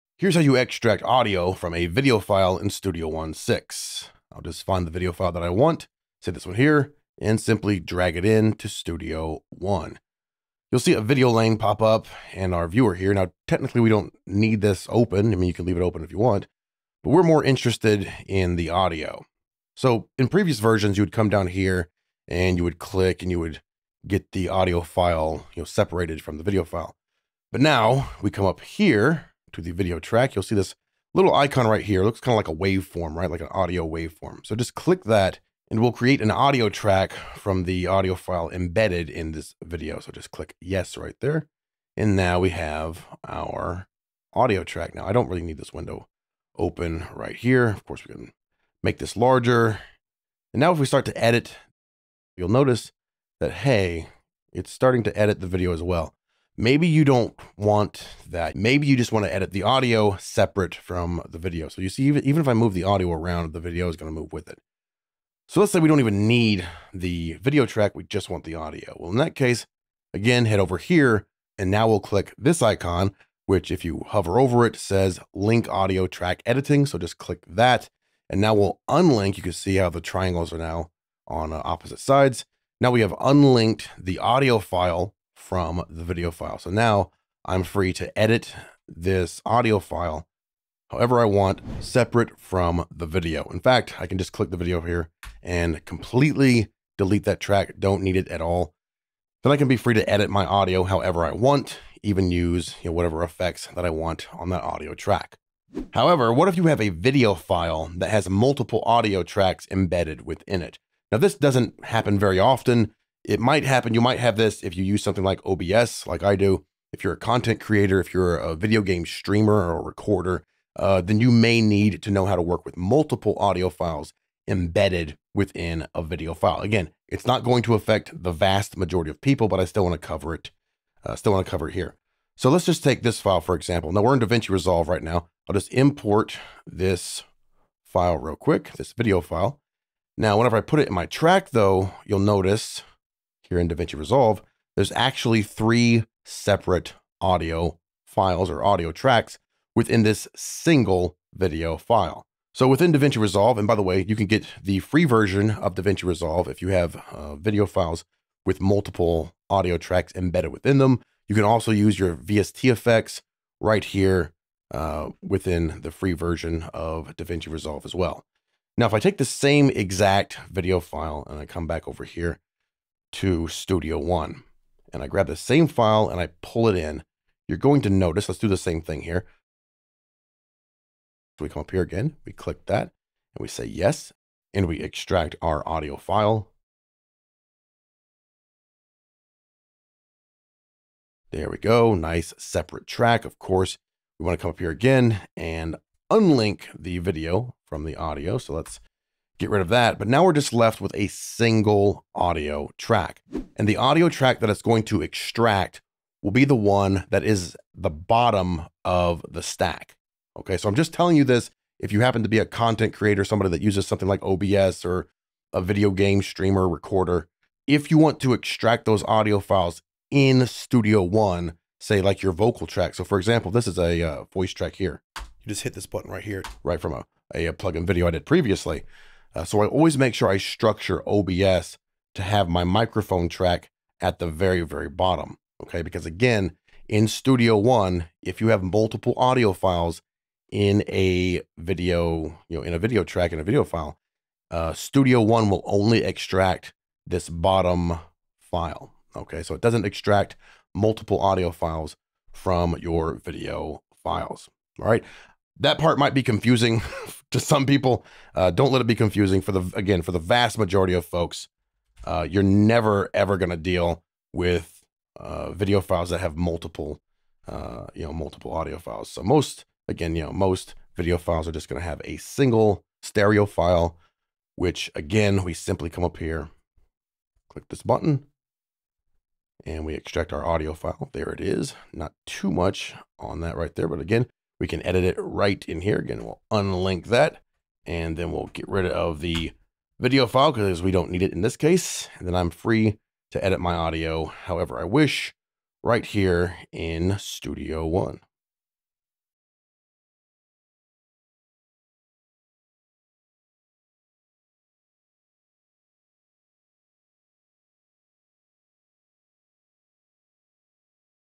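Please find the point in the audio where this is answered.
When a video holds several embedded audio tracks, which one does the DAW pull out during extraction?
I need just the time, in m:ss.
3:27.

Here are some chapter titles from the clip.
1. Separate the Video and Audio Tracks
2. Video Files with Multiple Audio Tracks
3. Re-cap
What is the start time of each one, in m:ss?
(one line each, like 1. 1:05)
1. 0:51
2. 1:45
3. 4:17.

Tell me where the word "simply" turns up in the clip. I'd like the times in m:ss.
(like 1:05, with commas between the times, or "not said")
0:07, 4:35.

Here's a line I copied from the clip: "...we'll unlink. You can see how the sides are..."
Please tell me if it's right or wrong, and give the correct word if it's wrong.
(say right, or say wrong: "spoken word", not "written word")
wrong: "triangles", not "sides".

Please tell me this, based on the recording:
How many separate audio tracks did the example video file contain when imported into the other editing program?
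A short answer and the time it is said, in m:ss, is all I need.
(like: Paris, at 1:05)
3, at 2:25.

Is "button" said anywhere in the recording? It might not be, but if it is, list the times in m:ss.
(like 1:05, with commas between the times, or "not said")
3:45, 4:37.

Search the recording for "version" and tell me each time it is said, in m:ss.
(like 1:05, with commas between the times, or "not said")
0:20, 2:35, 2:46.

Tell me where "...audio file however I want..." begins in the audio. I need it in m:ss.
1:29.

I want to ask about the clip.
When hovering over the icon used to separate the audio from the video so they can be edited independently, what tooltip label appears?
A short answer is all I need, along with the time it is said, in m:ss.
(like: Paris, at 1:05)
link audio track editing, at 1:15.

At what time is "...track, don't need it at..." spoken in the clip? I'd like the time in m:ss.
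1:37.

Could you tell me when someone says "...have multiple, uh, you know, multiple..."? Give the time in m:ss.
4:26.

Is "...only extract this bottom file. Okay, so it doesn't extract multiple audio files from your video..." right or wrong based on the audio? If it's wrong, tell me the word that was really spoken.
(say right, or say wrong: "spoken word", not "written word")
right.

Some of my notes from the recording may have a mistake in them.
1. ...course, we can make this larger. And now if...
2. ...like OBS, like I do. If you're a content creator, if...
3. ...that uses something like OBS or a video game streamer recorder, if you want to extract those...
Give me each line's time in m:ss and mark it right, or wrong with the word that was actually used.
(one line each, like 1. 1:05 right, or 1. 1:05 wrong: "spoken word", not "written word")
1. 0:47 right
2. 1:55 right
3. 3:33 right.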